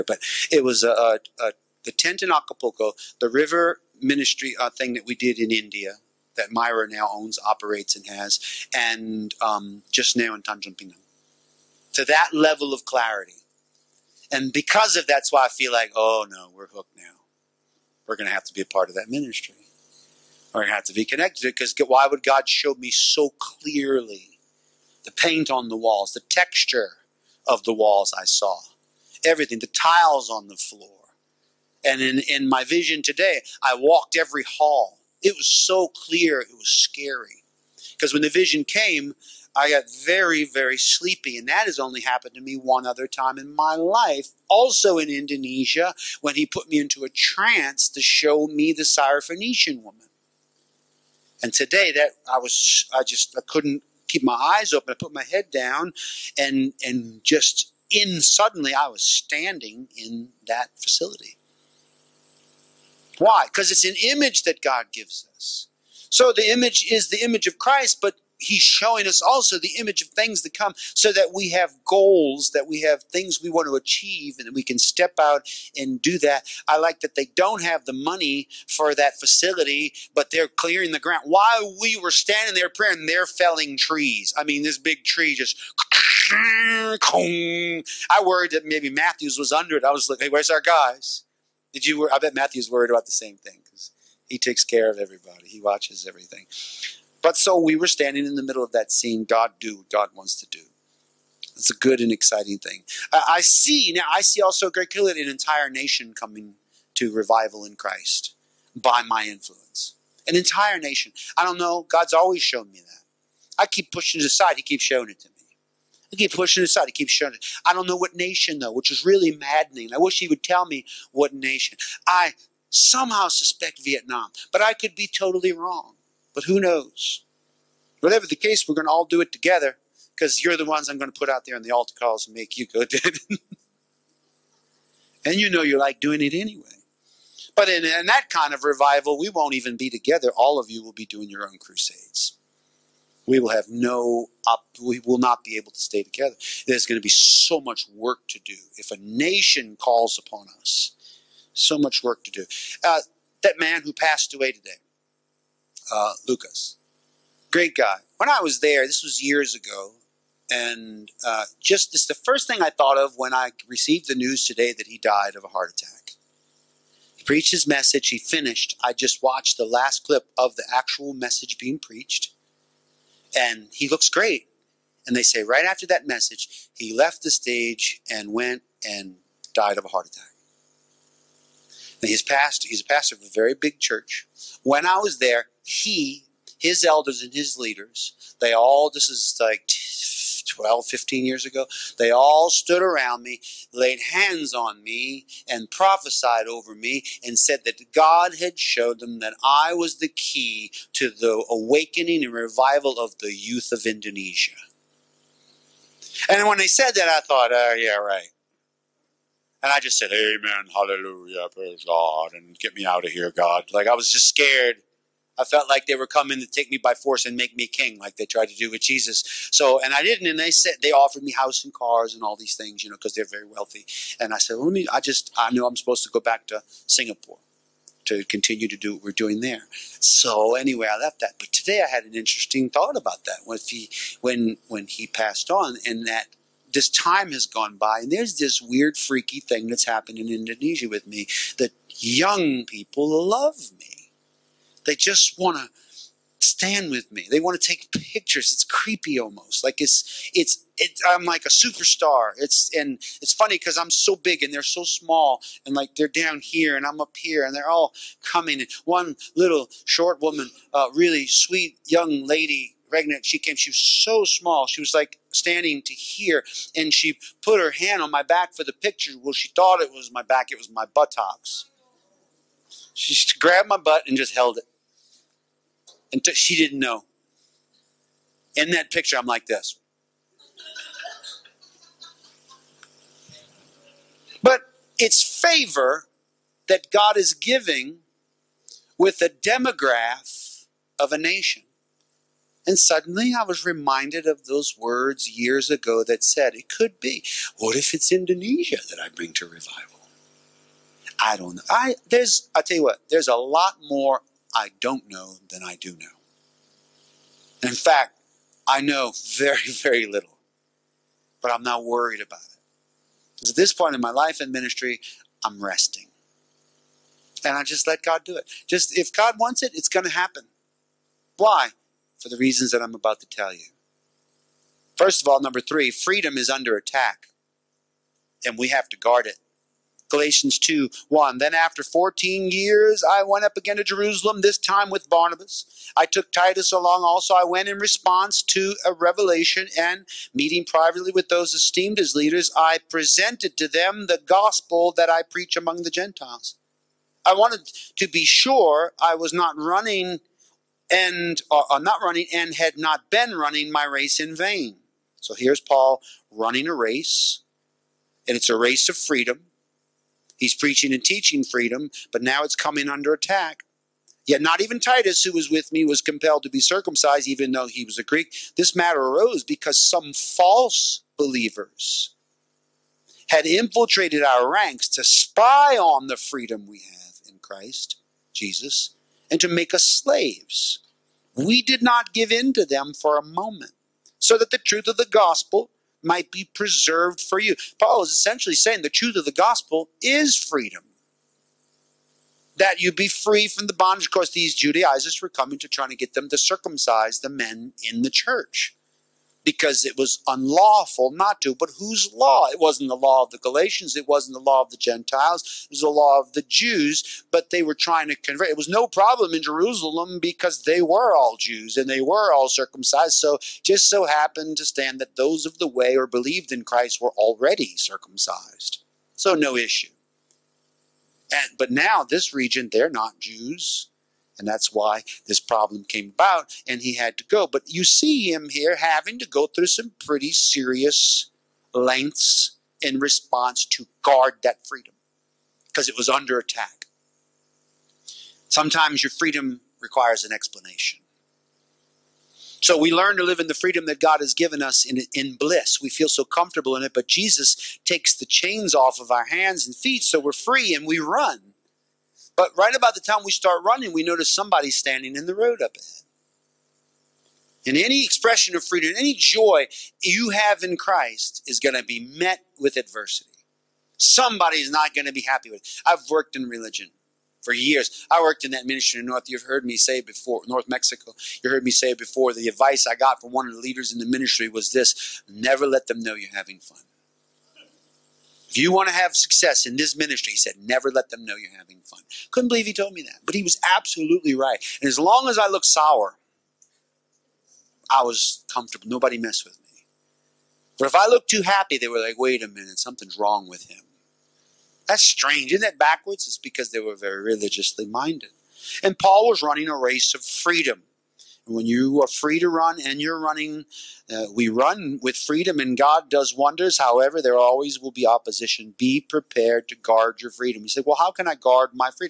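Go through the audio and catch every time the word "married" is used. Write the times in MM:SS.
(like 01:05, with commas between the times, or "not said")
not said.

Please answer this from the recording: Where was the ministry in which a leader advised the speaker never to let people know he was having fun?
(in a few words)
North Mexico.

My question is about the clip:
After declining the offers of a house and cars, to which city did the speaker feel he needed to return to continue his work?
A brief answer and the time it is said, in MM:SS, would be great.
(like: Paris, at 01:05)
Singapore, at 03:46.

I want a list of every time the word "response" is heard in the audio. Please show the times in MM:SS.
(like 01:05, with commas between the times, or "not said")
05:37, 07:12.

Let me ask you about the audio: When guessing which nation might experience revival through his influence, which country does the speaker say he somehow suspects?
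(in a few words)
Vietnam.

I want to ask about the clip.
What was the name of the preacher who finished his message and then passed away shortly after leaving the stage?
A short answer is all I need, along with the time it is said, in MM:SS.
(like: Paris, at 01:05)
Lucas, at 02:36.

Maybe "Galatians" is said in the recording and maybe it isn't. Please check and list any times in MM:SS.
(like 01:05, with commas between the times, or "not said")
05:30, 06:43.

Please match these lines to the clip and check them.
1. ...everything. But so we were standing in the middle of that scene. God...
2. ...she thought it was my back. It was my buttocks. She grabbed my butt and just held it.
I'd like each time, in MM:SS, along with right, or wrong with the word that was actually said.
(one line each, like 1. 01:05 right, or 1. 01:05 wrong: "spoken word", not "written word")
1. 01:36 right
2. 04:29 right.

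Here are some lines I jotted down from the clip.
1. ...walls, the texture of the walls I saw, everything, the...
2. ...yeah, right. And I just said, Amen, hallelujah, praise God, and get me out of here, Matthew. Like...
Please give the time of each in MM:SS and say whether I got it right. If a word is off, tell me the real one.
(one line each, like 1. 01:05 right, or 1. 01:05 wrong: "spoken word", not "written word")
1. 00:25 right
2. 03:27 wrong: "God", not "Matthew".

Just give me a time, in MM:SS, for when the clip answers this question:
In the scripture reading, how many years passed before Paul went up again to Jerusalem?
05:31.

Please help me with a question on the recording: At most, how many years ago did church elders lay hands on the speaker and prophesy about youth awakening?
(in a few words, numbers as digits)
15.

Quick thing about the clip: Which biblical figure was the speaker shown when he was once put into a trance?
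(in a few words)
Syrophoenician woman.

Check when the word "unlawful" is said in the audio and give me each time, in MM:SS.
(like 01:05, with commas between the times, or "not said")
06:40.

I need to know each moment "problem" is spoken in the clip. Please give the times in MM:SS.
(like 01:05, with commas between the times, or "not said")
06:48, 07:05.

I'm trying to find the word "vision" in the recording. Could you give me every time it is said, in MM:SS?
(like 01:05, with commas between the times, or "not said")
00:32, 00:38.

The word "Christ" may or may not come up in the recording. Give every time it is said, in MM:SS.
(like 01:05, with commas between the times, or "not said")
01:07, 01:47, 06:17, 06:56, 07:40.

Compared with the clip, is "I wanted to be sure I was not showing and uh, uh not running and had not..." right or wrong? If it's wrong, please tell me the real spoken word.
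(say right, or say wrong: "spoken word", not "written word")
wrong: "running", not "showing".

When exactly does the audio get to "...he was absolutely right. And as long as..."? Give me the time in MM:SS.
08:03.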